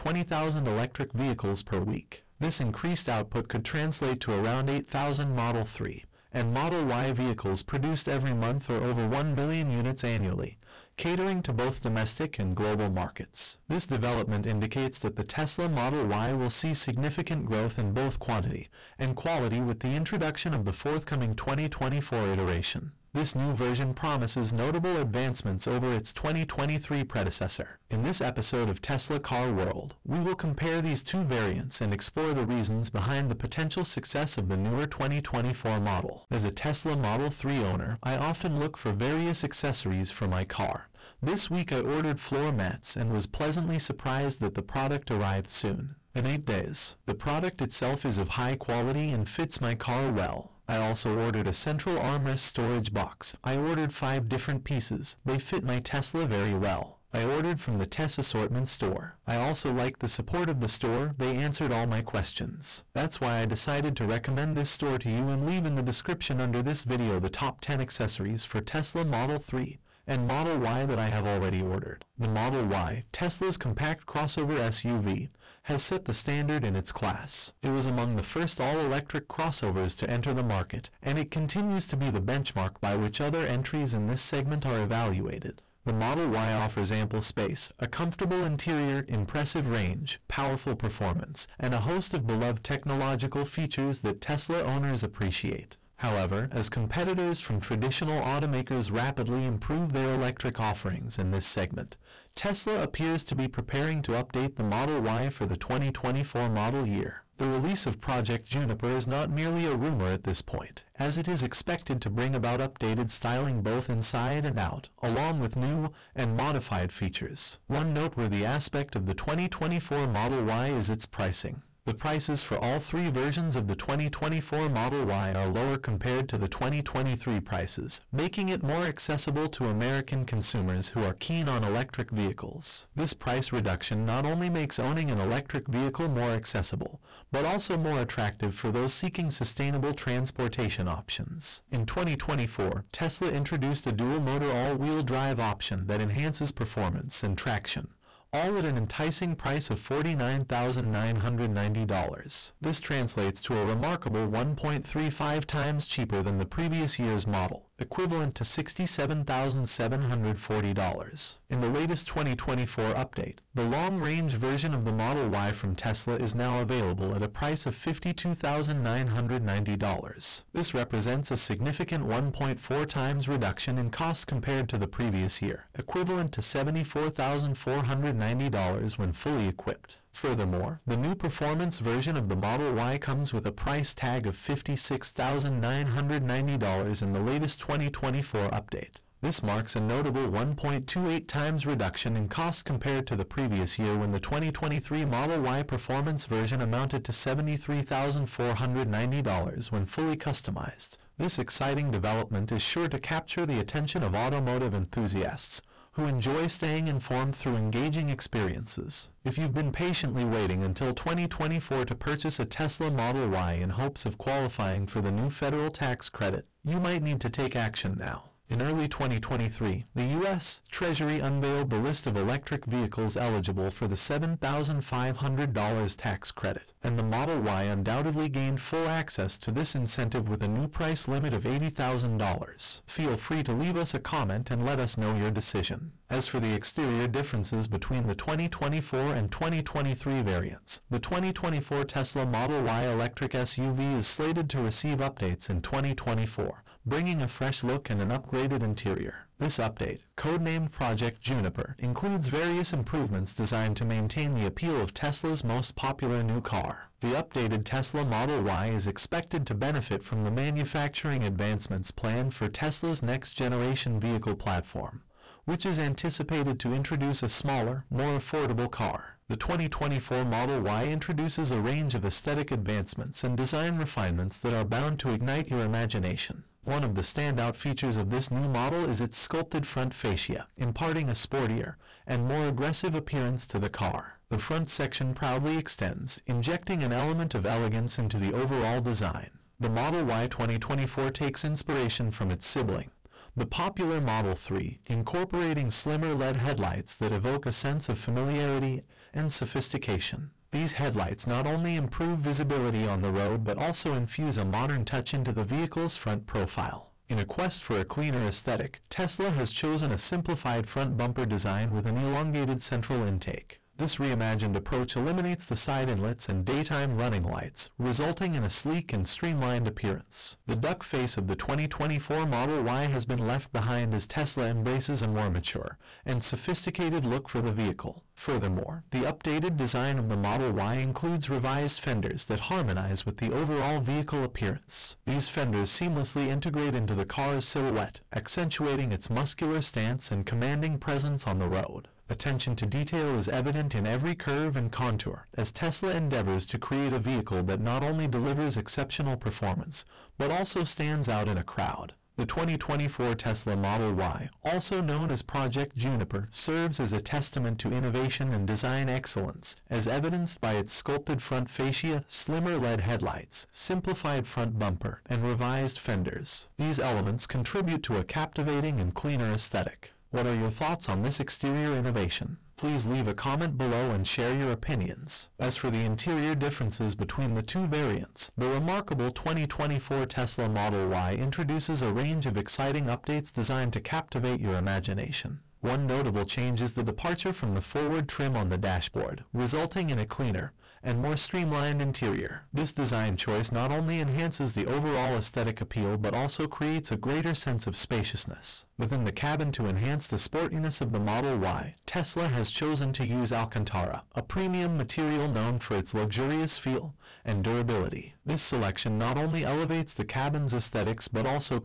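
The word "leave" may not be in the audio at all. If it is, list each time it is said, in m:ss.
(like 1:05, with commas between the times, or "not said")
1:05, 3:53, 6:12.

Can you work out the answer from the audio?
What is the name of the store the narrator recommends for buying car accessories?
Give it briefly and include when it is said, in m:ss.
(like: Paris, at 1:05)
Tess Assortment, at 0:57.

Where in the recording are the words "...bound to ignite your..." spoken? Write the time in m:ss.
4:34.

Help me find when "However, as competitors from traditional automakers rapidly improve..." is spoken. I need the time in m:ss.
1:35.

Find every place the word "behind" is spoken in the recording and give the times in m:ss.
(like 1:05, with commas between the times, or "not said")
0:32, 5:23.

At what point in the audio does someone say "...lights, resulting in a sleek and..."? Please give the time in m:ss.
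5:17.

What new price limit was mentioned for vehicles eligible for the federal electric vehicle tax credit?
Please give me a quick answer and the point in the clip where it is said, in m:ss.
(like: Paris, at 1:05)
$80,000, at 3:51.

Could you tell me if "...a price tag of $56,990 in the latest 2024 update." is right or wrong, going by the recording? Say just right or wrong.
right.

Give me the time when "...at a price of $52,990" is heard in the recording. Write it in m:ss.
2:47.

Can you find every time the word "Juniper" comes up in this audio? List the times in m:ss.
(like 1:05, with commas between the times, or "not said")
1:48, 4:11, 5:55.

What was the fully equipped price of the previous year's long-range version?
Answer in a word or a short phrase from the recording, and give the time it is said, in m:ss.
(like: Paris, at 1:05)
$74,490, at 2:56.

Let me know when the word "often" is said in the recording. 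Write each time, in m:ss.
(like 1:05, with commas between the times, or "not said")
0:38.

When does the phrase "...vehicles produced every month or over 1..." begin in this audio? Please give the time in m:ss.
0:07.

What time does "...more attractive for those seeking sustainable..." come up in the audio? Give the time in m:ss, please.
2:17.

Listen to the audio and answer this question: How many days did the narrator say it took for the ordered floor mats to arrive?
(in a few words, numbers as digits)
8.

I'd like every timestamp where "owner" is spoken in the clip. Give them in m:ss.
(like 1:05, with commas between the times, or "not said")
0:37, 1:34.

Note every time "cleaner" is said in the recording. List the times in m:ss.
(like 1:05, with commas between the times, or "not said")
5:07, 6:08, 6:30.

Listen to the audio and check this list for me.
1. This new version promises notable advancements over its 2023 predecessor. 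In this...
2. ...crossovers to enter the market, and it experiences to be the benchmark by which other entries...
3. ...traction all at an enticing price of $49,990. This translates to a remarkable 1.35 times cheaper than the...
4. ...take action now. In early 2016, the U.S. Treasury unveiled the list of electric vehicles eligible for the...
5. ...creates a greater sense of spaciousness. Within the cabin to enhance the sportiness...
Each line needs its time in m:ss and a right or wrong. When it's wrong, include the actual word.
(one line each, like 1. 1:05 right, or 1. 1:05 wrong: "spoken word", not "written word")
1. 0:23 right
2. 1:19 wrong: "continues", not "experiences"
3. 2:27 right
4. 3:37 wrong: "2023", not "2016"
5. 6:36 right.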